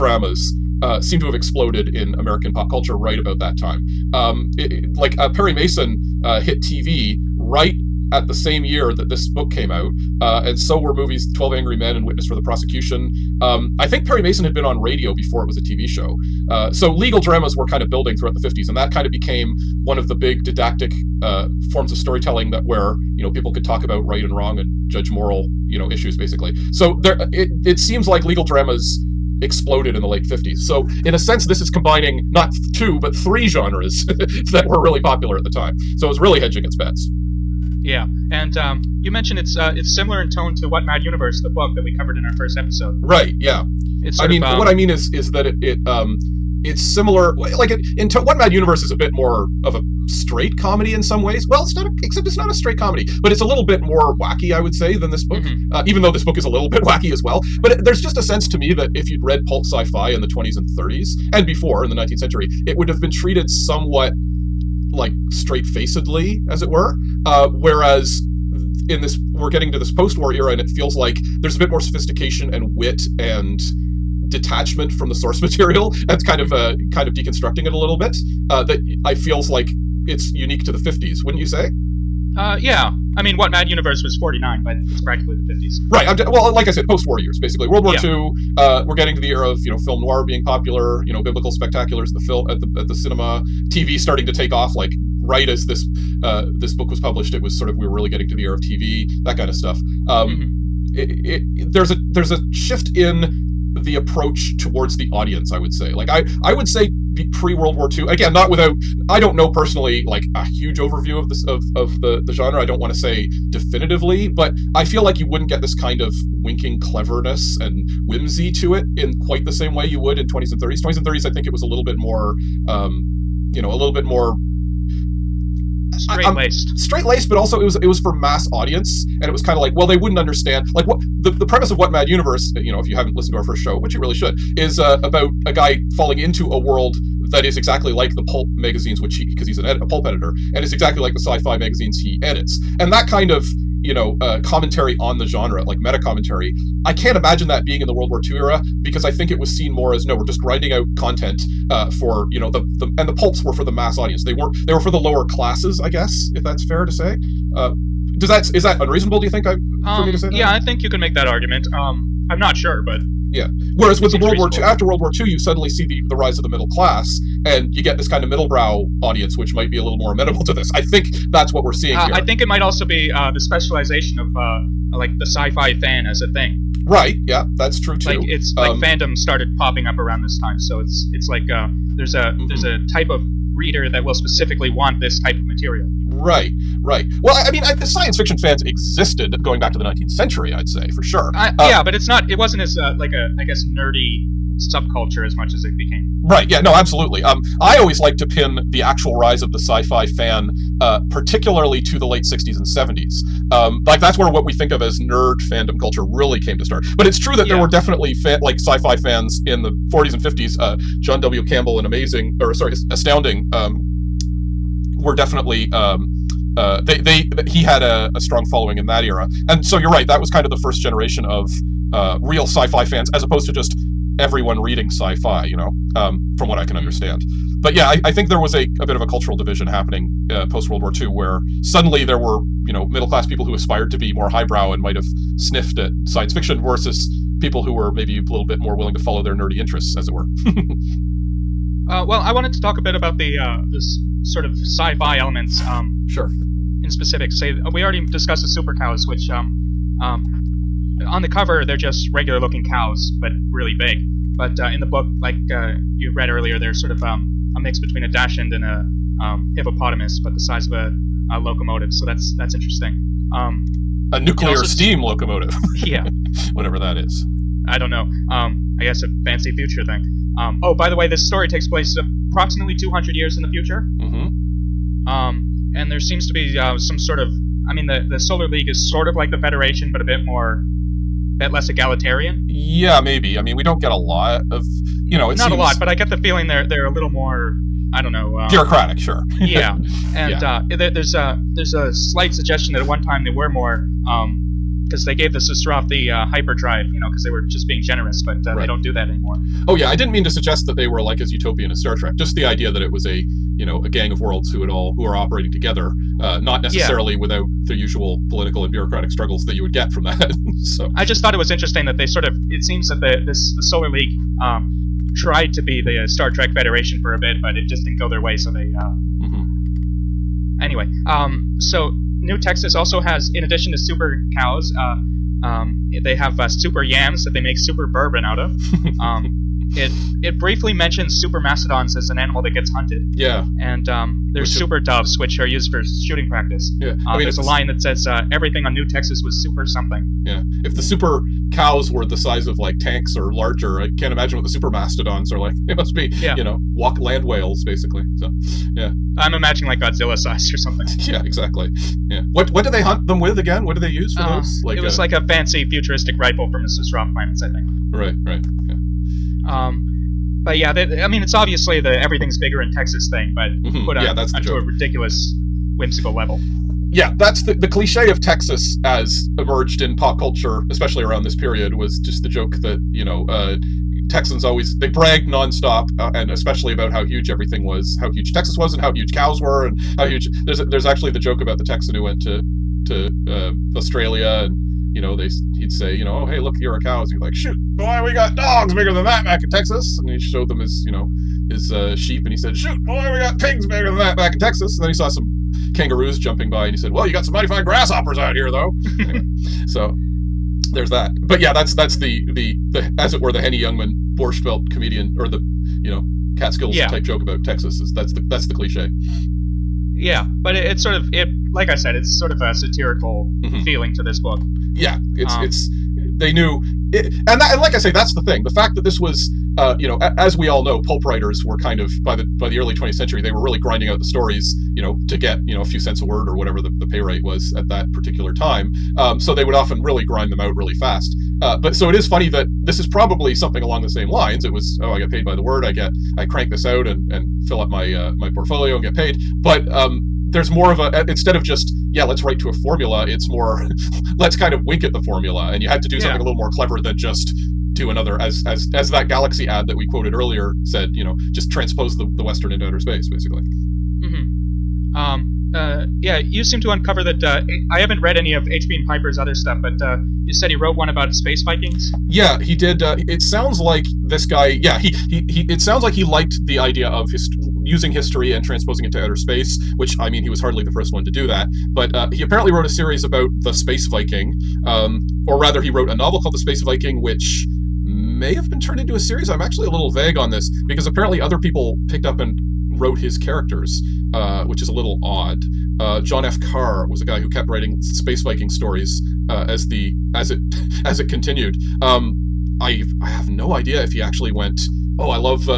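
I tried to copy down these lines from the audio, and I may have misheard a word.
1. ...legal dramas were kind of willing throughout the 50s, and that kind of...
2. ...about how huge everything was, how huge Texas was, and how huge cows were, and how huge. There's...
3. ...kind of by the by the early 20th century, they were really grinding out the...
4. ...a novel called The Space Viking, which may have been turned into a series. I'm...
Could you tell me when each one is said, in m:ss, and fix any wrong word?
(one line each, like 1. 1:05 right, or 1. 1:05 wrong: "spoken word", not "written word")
1. 0:16 wrong: "building", not "willing"
2. 6:16 right
3. 7:01 right
4. 7:55 right.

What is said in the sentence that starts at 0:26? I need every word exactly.
So there, uh, it it seems like legal dramas exploded in the late 50s.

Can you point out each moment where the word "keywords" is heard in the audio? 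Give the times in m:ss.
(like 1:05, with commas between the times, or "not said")
not said.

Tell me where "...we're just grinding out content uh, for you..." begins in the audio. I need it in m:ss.
2:30.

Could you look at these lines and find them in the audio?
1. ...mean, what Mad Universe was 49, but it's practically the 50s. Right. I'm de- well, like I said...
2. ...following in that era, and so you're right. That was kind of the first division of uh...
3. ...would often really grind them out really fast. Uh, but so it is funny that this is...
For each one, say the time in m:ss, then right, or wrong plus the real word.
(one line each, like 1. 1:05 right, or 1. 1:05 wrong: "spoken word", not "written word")
1. 1:23 right
2. 3:38 wrong: "generation", not "division"
3. 7:09 right.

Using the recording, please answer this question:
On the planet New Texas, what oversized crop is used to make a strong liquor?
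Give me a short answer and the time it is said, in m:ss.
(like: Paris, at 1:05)
super yams, at 5:26.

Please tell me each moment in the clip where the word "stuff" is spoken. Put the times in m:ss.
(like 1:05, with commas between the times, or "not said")
1:39, 7:39.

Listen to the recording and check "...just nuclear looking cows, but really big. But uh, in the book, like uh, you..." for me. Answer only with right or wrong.
wrong.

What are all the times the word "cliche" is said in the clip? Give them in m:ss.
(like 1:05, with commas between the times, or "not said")
6:07, 6:48.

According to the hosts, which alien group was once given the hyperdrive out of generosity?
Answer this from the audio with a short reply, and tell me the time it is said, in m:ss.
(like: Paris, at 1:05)
Sustrov, at 4:55.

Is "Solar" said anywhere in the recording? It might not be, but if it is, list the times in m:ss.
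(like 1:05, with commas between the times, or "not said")
4:38, 5:13.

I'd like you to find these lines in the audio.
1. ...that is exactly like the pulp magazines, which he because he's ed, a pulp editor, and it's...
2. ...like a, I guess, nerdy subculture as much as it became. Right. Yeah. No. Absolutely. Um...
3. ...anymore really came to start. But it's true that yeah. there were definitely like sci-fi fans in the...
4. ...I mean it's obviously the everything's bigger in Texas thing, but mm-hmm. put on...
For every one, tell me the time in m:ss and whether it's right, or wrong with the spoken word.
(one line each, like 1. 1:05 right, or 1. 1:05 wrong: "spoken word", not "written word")
1. 2:17 right
2. 3:12 right
3. 3:25 wrong: "culture", not "anymore"
4. 6:01 right.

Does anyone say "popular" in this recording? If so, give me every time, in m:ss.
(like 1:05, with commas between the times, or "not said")
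0:34, 1:30.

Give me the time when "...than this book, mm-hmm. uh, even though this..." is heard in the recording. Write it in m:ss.
0:54.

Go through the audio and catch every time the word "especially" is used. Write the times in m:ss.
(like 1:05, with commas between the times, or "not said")
6:10, 6:16.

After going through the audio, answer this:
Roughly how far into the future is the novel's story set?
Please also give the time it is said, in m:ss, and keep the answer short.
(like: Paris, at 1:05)
200 years, at 4:32.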